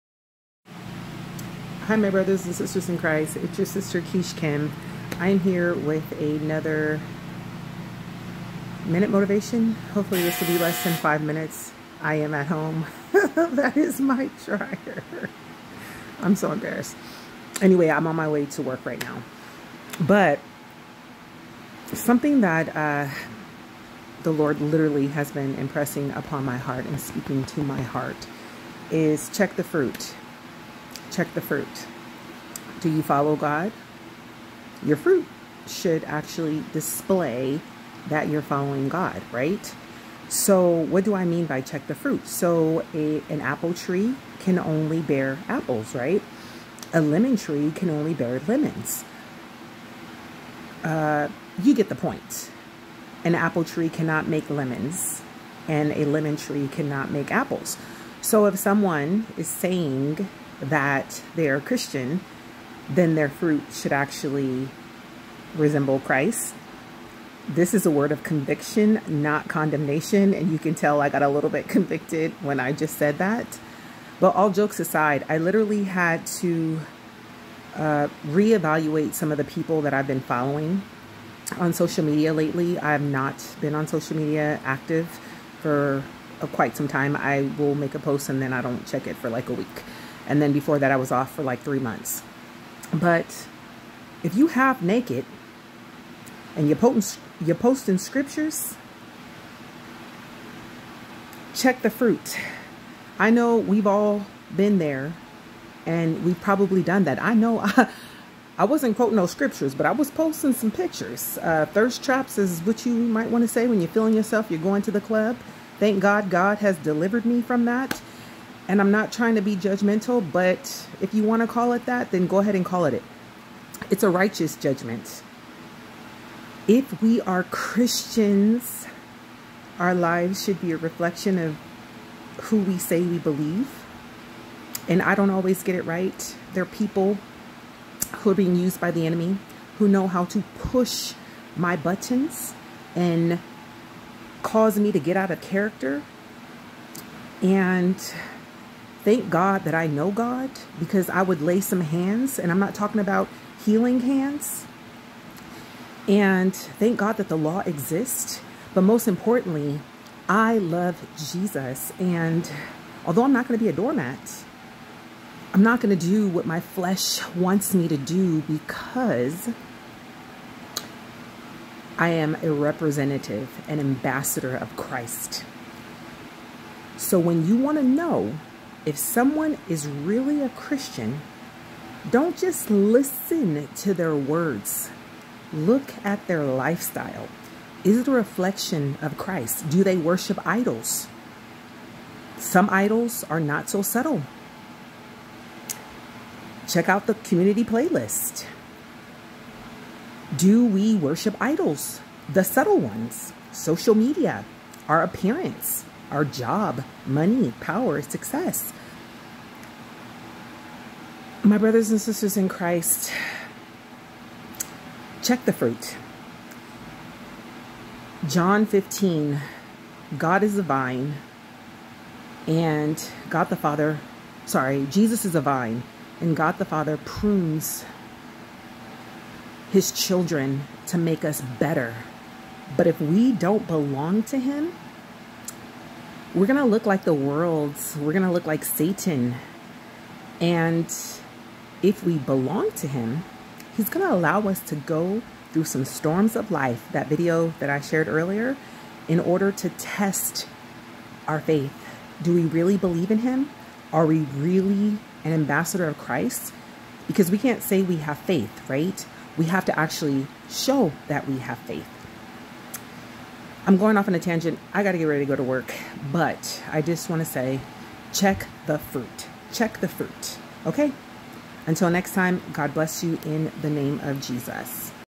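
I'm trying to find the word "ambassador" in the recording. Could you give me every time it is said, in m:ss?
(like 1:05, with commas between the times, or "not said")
2:53, 4:15.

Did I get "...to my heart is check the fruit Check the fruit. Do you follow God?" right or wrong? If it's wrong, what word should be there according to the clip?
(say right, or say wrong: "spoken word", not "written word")
right.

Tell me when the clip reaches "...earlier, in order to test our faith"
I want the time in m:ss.
4:08.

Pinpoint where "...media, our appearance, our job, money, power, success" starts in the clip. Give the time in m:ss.
3:23.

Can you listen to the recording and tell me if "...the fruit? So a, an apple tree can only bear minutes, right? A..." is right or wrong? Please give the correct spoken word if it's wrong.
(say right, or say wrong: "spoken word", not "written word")
wrong: "apples", not "minutes".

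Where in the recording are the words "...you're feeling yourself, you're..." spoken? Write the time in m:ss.
1:53.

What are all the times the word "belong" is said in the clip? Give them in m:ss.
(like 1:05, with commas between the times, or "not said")
3:53, 4:02.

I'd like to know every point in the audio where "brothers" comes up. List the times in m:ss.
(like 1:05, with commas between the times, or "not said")
0:02, 3:31.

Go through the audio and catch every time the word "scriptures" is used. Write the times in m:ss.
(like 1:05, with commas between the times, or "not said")
1:37, 1:49.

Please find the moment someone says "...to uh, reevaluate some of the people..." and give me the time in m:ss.
1:16.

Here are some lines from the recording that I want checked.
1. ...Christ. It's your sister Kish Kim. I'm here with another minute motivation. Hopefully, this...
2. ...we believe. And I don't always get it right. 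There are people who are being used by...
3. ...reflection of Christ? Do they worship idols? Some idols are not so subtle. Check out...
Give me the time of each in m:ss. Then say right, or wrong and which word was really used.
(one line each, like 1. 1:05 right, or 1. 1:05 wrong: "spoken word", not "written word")
1. 0:02 right
2. 2:13 right
3. 3:08 right.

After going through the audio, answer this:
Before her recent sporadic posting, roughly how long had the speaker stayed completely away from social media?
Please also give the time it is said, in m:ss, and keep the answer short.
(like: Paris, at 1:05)
3 months, at 1:31.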